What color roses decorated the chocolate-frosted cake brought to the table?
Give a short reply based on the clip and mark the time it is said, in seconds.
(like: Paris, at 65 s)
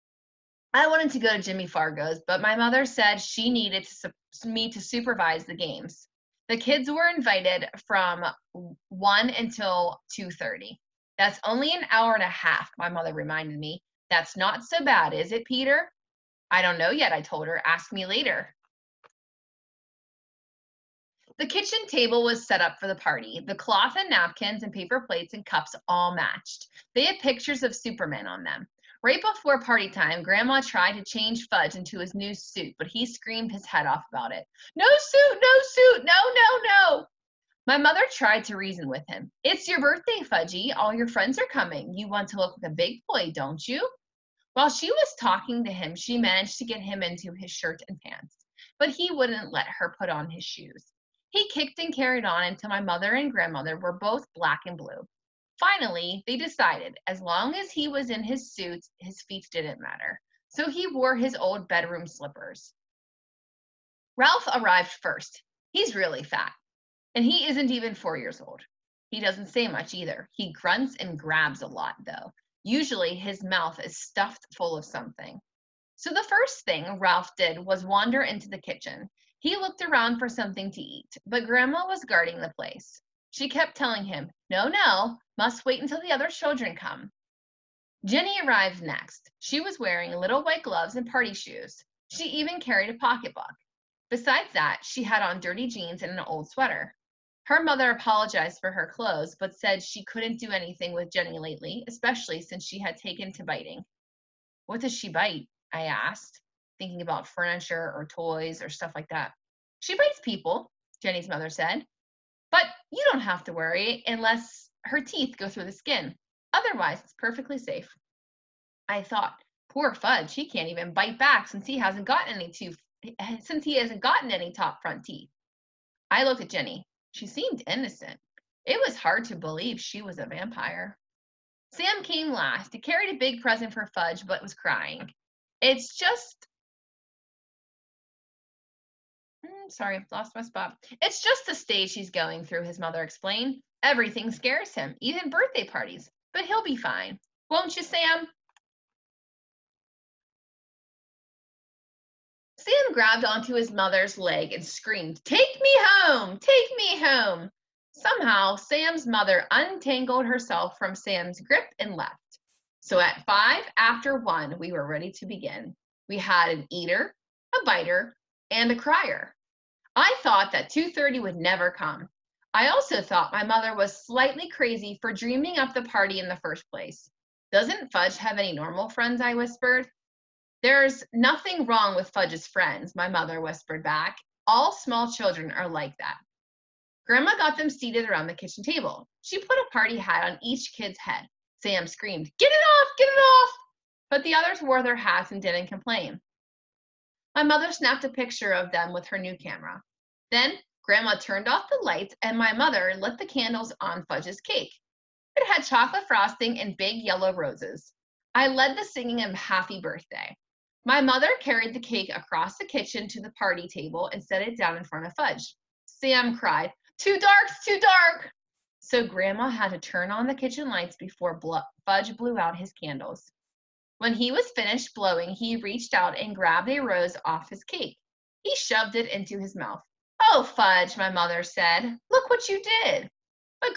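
yellow, at 206 s.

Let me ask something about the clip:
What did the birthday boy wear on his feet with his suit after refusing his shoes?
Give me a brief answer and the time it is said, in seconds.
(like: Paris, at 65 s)
his old bedroom slippers, at 61 s.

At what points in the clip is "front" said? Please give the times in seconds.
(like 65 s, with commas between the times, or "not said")
124 s, 214 s.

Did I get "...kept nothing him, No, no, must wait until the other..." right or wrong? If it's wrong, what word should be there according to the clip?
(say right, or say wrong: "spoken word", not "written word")
wrong: "telling", not "nothing".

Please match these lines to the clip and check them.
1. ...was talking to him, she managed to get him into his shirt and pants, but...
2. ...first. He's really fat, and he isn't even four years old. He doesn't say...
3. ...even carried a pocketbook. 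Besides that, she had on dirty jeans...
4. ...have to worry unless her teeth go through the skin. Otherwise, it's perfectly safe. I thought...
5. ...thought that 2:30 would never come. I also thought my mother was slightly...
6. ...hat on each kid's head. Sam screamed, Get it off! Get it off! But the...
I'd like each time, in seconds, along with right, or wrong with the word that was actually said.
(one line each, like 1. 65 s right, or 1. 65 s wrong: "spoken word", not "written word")
1. 44 s right
2. 65 s right
3. 92 s right
4. 113 s right
5. 170 s right
6. 189 s right.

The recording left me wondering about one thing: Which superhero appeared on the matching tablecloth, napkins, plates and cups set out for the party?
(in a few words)
Superman.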